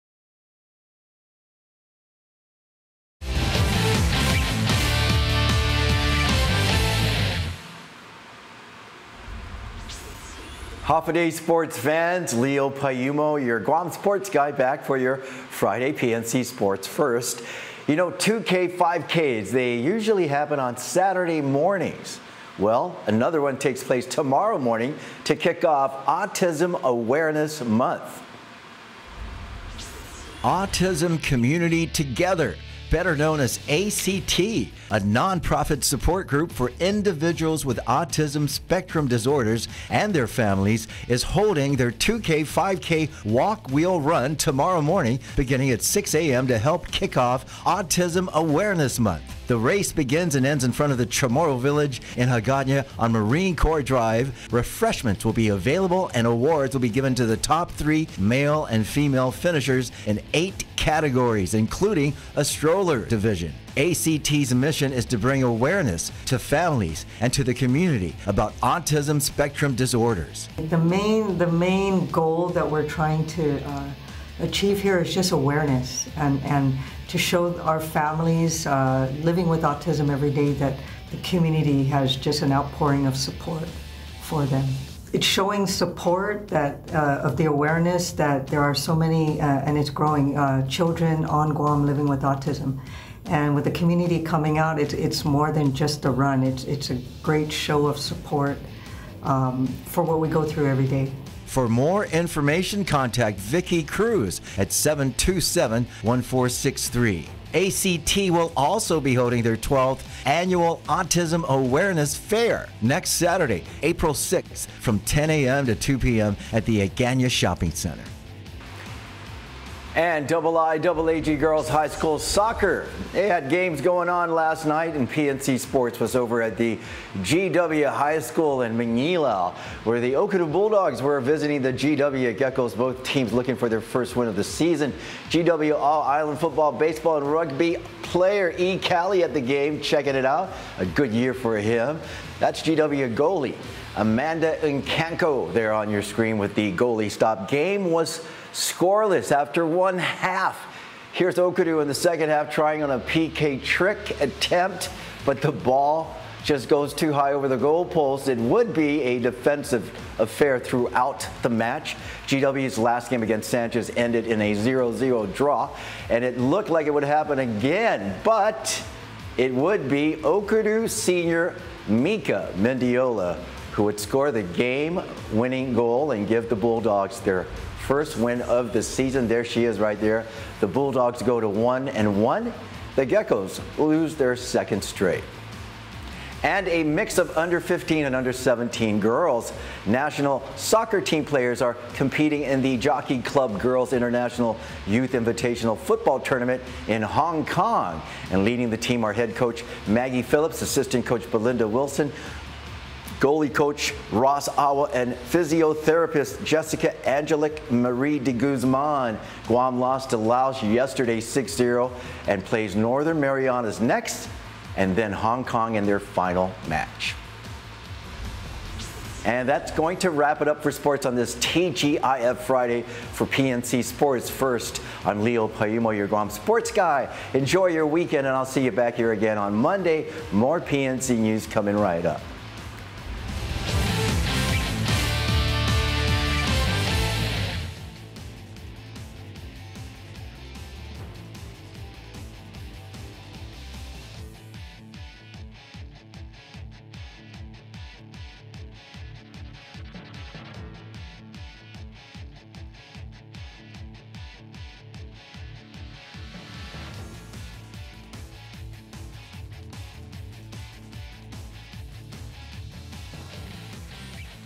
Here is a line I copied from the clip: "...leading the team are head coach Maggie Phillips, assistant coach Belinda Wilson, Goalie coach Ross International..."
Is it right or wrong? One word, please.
wrong.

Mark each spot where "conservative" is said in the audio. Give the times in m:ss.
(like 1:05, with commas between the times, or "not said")
not said.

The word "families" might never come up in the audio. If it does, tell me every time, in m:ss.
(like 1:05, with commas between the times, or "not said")
0:40, 1:06, 1:17.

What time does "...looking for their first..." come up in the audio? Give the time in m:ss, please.
2:13.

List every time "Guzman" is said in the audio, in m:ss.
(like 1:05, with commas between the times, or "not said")
3:28.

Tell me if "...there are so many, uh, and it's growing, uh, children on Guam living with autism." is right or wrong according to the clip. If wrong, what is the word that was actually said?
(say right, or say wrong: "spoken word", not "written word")
right.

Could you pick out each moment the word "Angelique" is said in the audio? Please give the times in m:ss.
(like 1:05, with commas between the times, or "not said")
3:27.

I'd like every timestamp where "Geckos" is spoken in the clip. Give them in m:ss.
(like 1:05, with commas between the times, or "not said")
2:12, 3:03.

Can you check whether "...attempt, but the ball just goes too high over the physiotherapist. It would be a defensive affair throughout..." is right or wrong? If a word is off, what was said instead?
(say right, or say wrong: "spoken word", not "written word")
wrong: "goalpost", not "physiotherapist".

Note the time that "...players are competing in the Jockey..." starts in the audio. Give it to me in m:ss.
3:11.